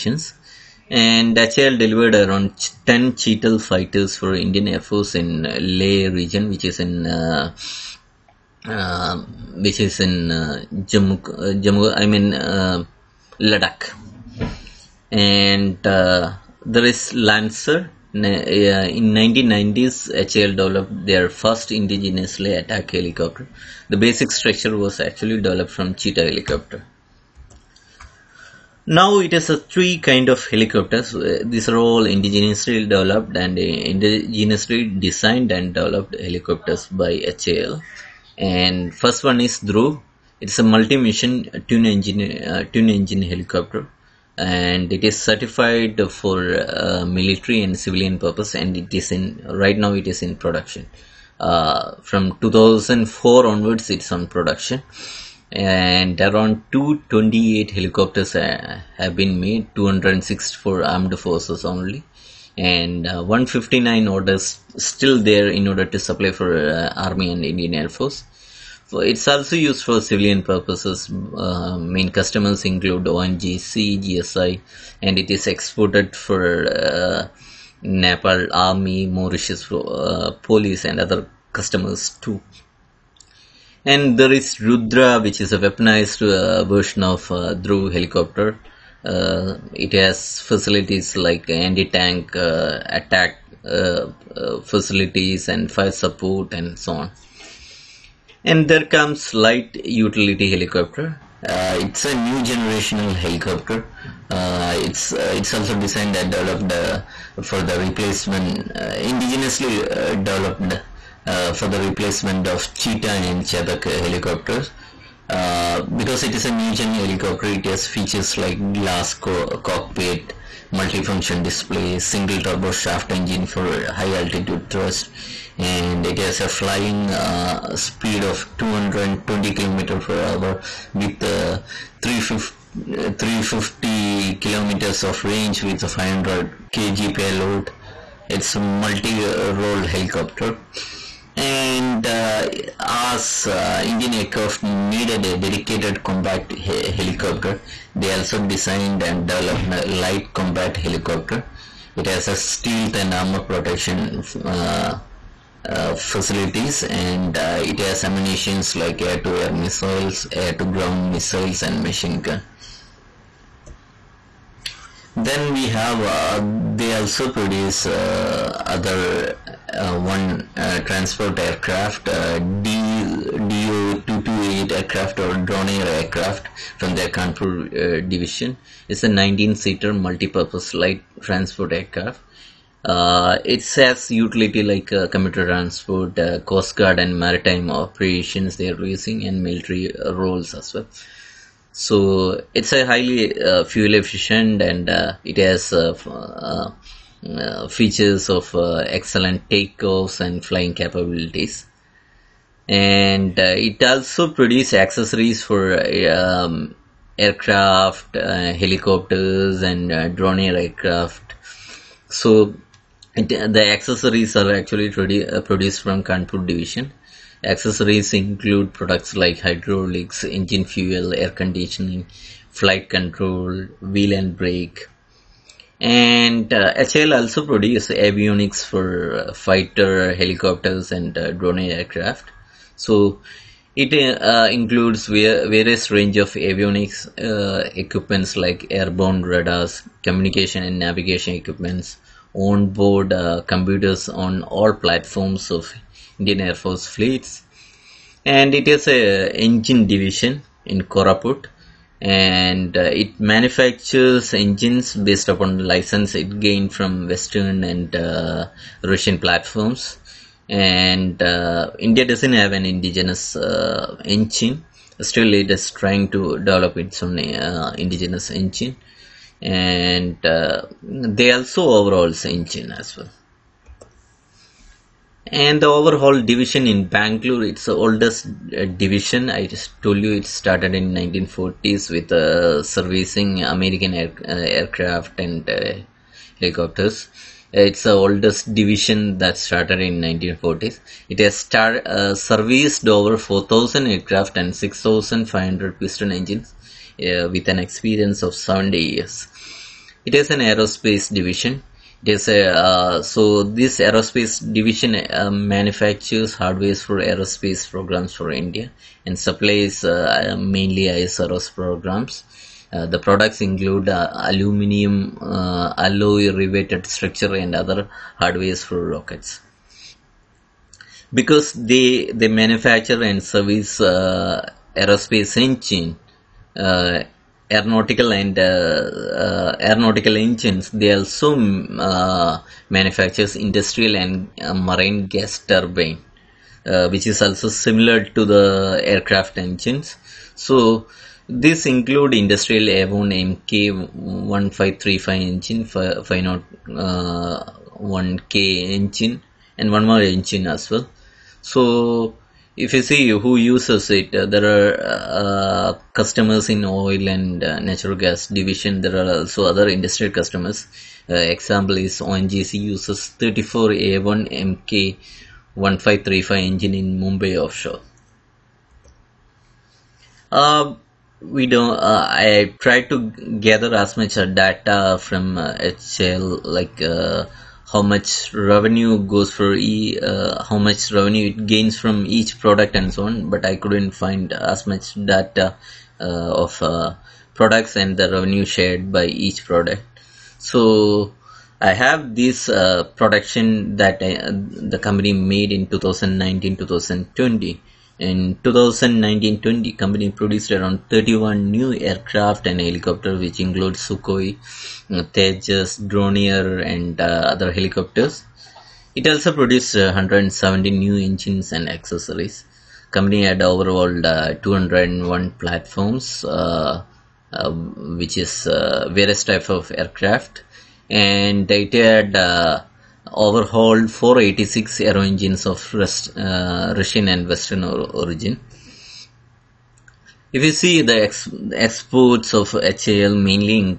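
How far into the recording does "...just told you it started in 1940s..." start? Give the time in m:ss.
4:39.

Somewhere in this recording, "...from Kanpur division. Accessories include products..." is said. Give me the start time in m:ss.
3:35.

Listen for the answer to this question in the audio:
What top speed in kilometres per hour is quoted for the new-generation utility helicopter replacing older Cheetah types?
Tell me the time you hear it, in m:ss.
2:08.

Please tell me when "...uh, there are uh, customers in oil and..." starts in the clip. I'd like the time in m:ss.
5:54.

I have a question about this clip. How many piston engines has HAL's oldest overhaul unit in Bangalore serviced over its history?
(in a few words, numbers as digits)
6500.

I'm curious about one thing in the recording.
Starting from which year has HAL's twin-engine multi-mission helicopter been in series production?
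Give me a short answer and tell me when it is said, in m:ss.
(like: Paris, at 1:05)
2004, at 0:52.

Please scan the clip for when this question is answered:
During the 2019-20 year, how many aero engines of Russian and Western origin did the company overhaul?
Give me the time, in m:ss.
7:03.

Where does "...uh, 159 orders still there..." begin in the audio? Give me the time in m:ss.
1:03.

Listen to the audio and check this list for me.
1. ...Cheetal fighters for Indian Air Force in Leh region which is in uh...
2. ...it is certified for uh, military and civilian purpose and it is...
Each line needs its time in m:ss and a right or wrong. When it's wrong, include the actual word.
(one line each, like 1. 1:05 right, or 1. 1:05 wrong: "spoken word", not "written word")
1. 0:03 right
2. 0:44 right.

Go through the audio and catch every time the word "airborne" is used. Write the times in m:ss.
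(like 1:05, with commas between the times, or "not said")
3:58.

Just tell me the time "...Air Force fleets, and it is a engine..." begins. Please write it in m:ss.
4:06.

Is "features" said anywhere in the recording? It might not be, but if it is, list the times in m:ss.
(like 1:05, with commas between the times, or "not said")
1:57, 3:17.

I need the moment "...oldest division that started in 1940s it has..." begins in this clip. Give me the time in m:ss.
4:47.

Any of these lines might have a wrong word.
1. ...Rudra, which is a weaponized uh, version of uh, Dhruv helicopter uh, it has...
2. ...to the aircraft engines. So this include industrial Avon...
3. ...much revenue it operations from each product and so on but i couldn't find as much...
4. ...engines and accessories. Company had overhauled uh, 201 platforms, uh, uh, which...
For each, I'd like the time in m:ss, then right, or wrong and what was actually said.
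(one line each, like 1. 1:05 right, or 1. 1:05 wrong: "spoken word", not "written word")
1. 1:24 right
2. 5:38 right
3. 6:20 wrong: "gains", not "operations"
4. 6:50 right.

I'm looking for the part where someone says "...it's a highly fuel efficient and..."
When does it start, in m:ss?
3:12.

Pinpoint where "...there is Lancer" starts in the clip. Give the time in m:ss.
0:16.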